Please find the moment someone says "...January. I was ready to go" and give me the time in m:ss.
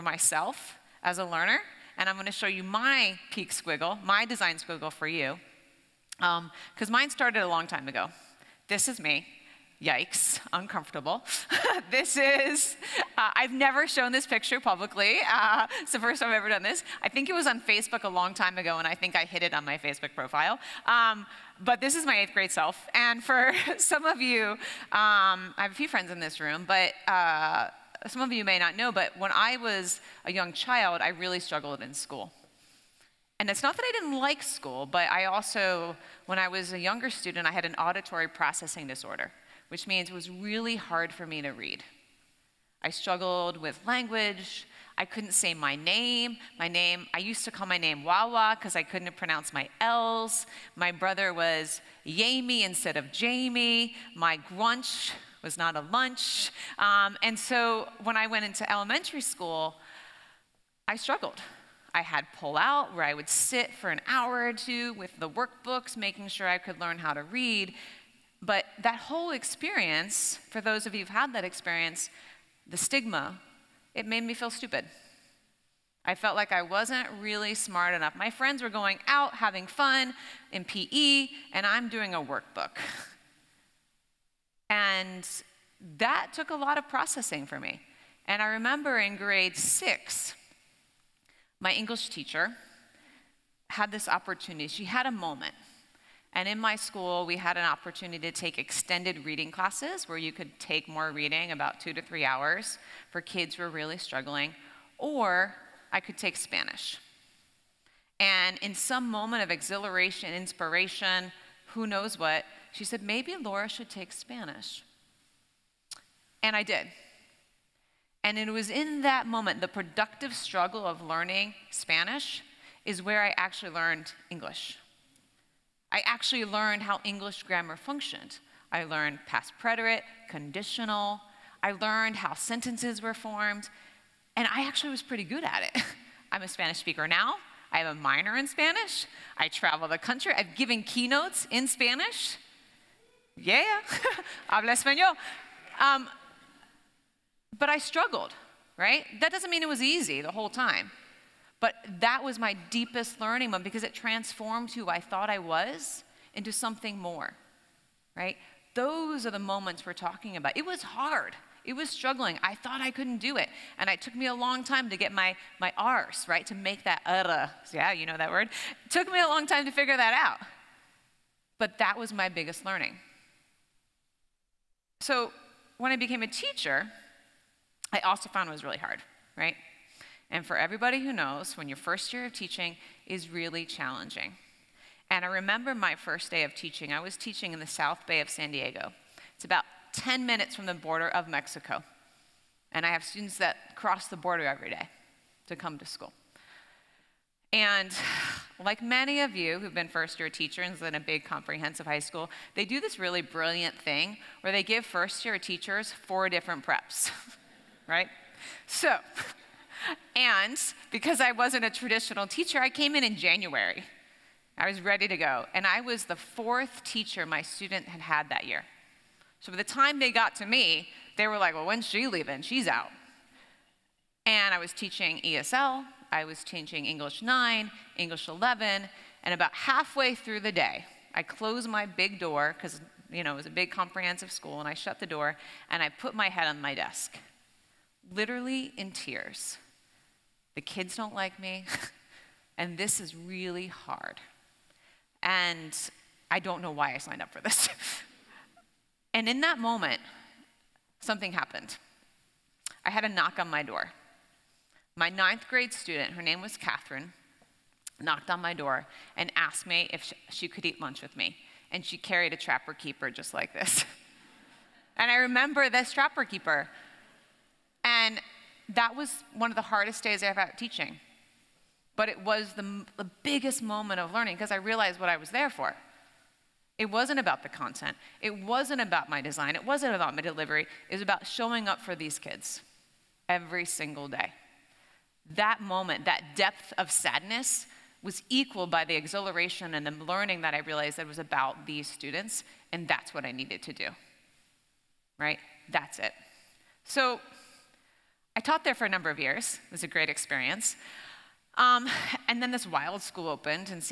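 3:33.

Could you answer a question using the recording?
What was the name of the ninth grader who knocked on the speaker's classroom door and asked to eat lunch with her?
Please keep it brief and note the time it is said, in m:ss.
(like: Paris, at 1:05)
Catherine, at 4:16.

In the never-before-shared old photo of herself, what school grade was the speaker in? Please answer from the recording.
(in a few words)
eighth grade.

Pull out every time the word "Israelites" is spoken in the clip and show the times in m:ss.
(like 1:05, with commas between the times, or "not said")
not said.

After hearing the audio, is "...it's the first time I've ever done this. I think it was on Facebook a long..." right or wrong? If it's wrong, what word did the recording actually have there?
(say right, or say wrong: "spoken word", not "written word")
right.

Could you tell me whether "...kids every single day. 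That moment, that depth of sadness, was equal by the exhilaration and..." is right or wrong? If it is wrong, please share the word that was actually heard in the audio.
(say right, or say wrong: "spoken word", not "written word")
right.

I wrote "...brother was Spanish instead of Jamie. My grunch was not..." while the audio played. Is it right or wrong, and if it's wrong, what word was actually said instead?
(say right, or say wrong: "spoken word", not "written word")
wrong: "Jamie", not "Spanish".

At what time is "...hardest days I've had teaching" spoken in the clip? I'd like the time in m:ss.
4:29.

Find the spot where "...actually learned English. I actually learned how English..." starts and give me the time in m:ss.
2:03.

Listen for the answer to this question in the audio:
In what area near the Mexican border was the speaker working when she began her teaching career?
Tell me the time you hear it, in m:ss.
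3:07.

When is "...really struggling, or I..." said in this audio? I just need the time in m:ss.
1:43.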